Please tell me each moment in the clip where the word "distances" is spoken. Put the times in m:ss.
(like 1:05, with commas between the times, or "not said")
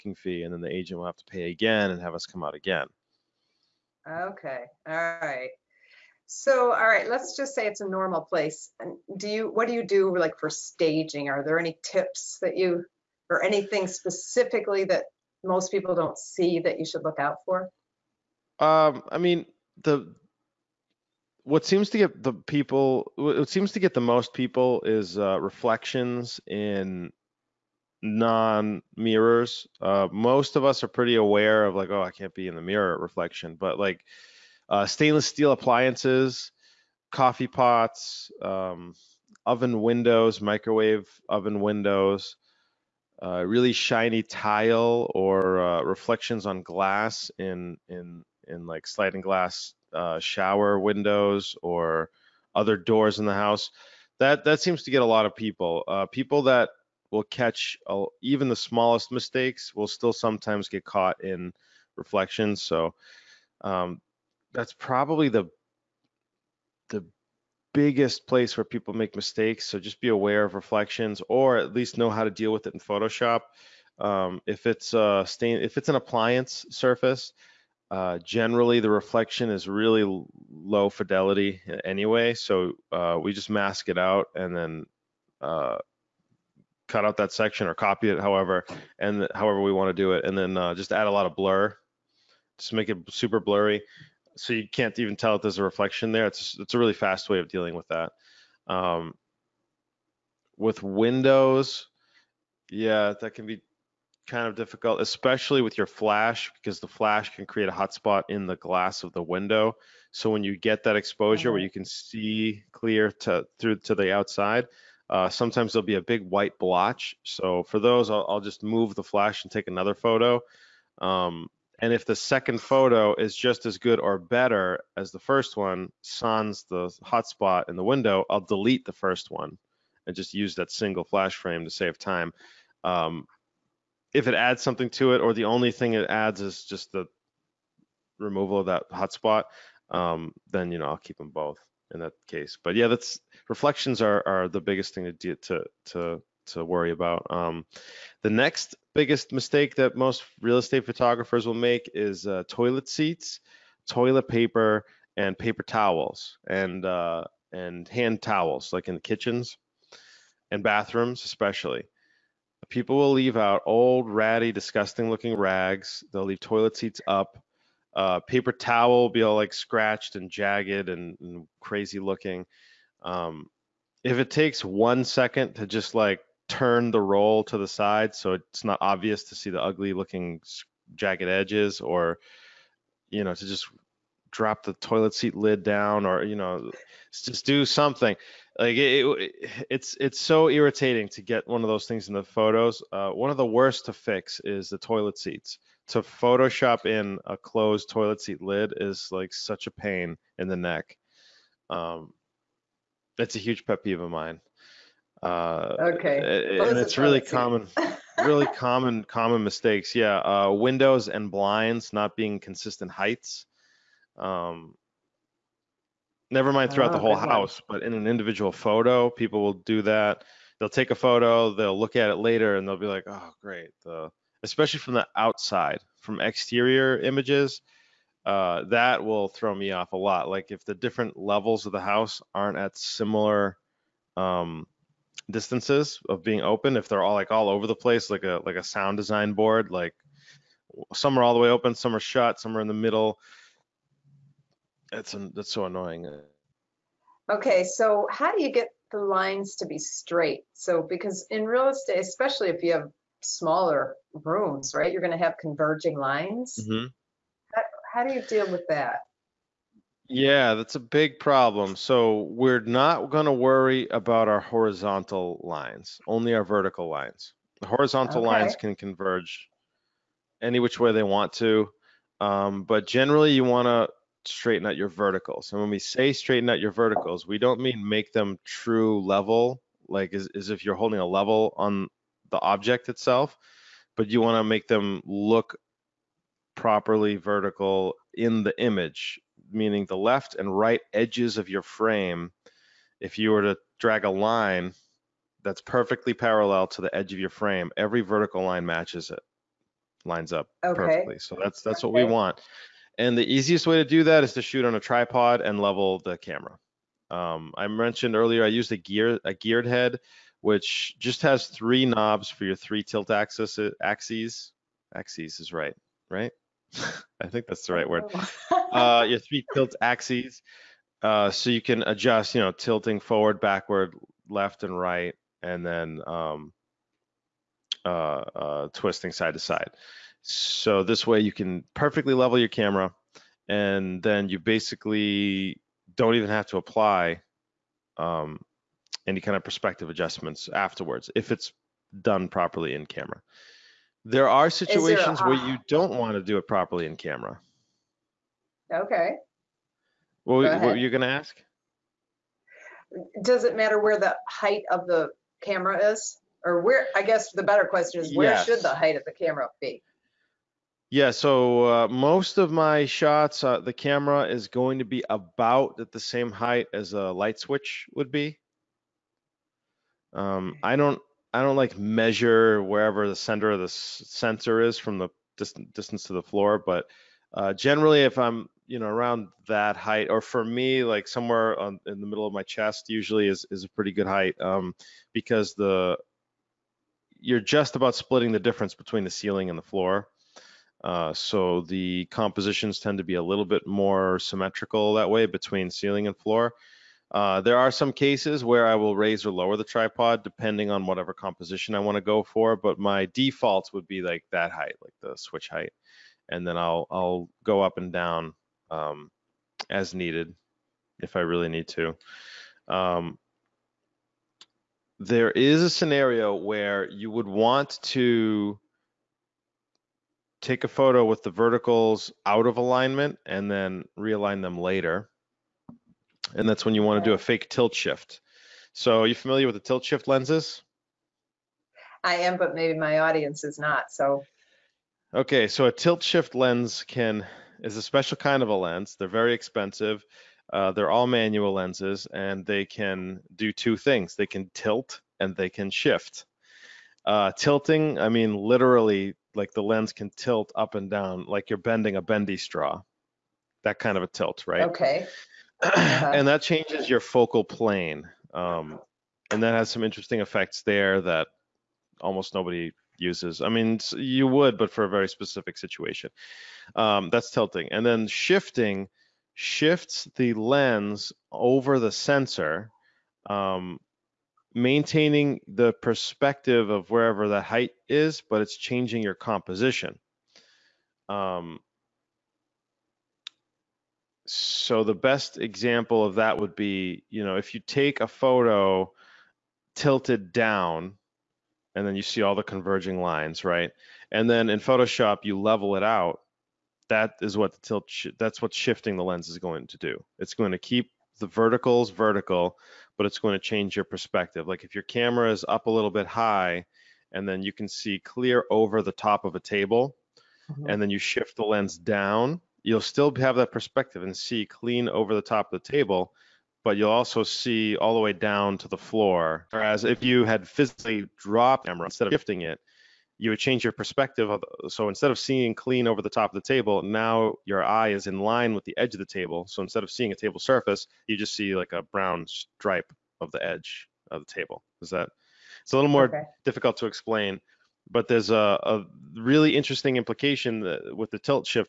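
3:55, 6:15.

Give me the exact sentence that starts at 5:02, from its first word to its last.
And the easiest way to do that is to shoot on a tripod and level the camera.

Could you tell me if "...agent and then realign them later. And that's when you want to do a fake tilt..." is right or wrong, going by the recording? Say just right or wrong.
wrong.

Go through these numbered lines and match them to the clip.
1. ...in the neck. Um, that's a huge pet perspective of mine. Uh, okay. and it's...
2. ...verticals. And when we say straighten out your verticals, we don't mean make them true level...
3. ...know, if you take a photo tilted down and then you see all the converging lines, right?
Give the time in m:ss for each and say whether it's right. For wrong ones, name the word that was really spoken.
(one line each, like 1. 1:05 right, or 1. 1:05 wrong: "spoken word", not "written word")
1. 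3:20 wrong: "peeve", not "perspective"
2. 4:34 right
3. 8:07 right.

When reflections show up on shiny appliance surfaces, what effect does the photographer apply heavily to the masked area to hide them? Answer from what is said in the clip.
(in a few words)
Blur.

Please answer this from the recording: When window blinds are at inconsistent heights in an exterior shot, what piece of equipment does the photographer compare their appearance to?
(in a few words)
A sound design board.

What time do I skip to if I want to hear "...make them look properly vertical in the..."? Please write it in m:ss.
4:44.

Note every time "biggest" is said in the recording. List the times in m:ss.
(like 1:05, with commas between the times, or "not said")
1:07, 2:24, 2:28.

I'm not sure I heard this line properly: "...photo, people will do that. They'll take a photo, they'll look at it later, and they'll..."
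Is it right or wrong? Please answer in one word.
right.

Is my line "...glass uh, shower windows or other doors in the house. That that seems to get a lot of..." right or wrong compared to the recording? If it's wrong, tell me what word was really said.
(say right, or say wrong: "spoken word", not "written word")
right.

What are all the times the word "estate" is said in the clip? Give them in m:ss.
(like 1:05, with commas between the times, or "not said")
2:30, 4:11.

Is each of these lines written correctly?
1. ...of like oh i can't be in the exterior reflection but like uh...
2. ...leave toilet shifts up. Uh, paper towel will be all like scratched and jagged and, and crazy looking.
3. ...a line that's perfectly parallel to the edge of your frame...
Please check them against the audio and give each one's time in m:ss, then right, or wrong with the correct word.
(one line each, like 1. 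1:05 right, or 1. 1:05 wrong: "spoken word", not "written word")
1. 0:31 wrong: "mirror", not "exterior"
2. 2:46 wrong: "seats", not "shifts"
3. 4:54 right.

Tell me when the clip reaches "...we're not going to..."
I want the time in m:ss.
4:22.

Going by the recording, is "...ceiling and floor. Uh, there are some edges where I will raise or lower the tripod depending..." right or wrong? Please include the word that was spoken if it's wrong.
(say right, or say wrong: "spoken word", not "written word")
wrong: "cases", not "edges".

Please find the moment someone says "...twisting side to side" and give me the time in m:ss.
5:28.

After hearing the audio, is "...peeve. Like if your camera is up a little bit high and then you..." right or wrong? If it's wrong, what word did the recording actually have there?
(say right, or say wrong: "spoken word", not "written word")
wrong: "perspective", not "peeve".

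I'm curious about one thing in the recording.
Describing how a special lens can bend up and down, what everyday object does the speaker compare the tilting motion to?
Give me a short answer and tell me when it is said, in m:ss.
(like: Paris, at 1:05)
A bendy straw, at 7:32.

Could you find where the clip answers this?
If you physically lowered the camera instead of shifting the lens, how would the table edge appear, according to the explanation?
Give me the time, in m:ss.
8:51.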